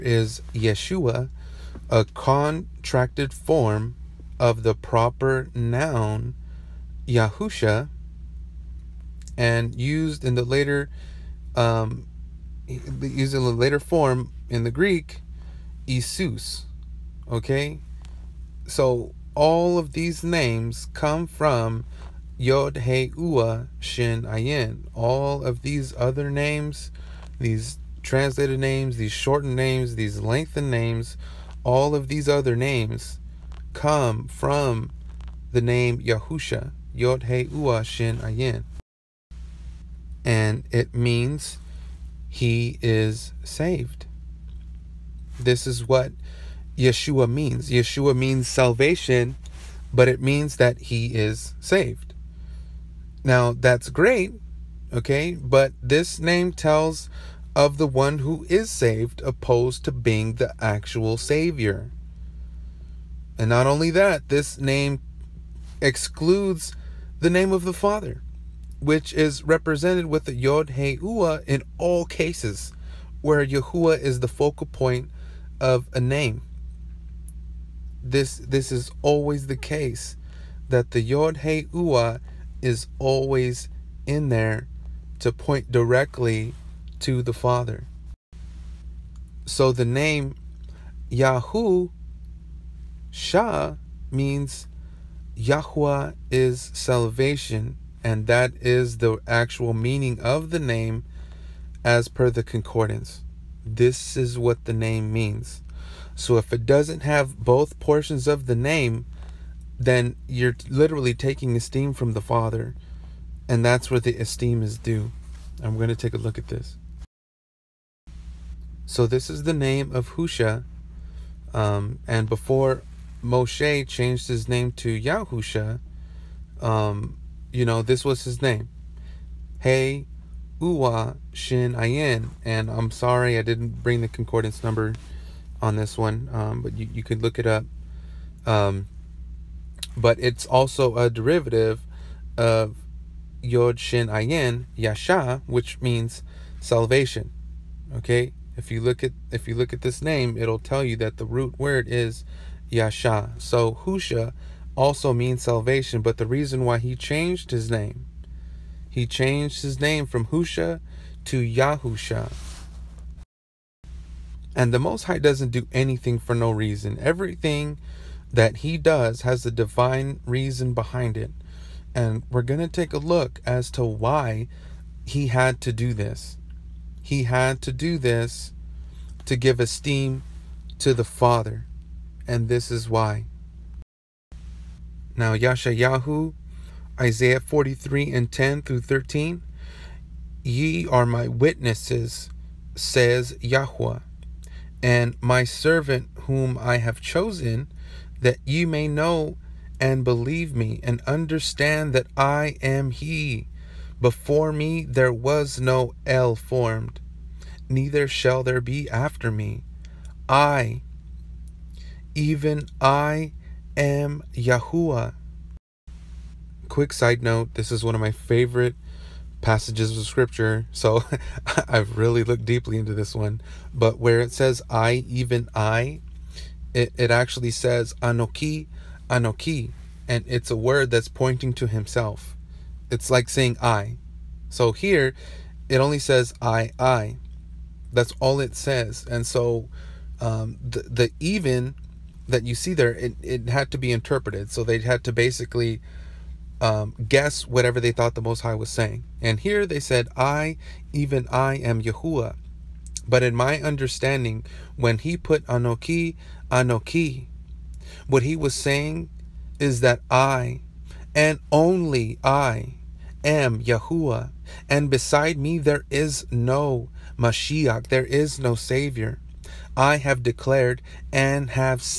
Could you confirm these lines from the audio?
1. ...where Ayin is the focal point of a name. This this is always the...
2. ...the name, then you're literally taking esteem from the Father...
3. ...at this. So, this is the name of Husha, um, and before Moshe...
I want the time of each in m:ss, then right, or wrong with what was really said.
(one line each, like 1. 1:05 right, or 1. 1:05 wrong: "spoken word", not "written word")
1. 1:13 wrong: "Yahuwah", not "Ayin"
2. 1:48 right
3. 1:56 right.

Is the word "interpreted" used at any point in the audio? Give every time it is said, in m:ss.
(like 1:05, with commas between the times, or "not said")
4:03.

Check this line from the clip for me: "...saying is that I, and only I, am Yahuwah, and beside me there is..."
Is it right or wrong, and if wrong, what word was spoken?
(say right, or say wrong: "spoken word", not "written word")
right.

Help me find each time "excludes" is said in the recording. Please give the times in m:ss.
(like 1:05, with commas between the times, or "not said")
1:05.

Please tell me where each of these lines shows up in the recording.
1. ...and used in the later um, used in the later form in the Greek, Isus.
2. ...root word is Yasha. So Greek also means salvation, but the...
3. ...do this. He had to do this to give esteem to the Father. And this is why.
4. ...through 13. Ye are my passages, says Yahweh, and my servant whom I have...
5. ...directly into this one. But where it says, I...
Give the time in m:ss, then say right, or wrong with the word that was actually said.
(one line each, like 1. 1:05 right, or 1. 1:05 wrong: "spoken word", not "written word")
1. 0:09 right
2. 2:31 wrong: "Husha", not "Greek"
3. 2:55 right
4. 3:08 wrong: "witnesses", not "passages"
5. 3:42 wrong: "deeply", not "directly".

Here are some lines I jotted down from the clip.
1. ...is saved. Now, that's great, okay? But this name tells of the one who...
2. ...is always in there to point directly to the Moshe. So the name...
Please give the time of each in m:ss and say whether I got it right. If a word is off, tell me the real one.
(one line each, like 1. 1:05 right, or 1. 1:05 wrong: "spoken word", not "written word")
1. 0:51 right
2. 1:22 wrong: "Father", not "Moshe".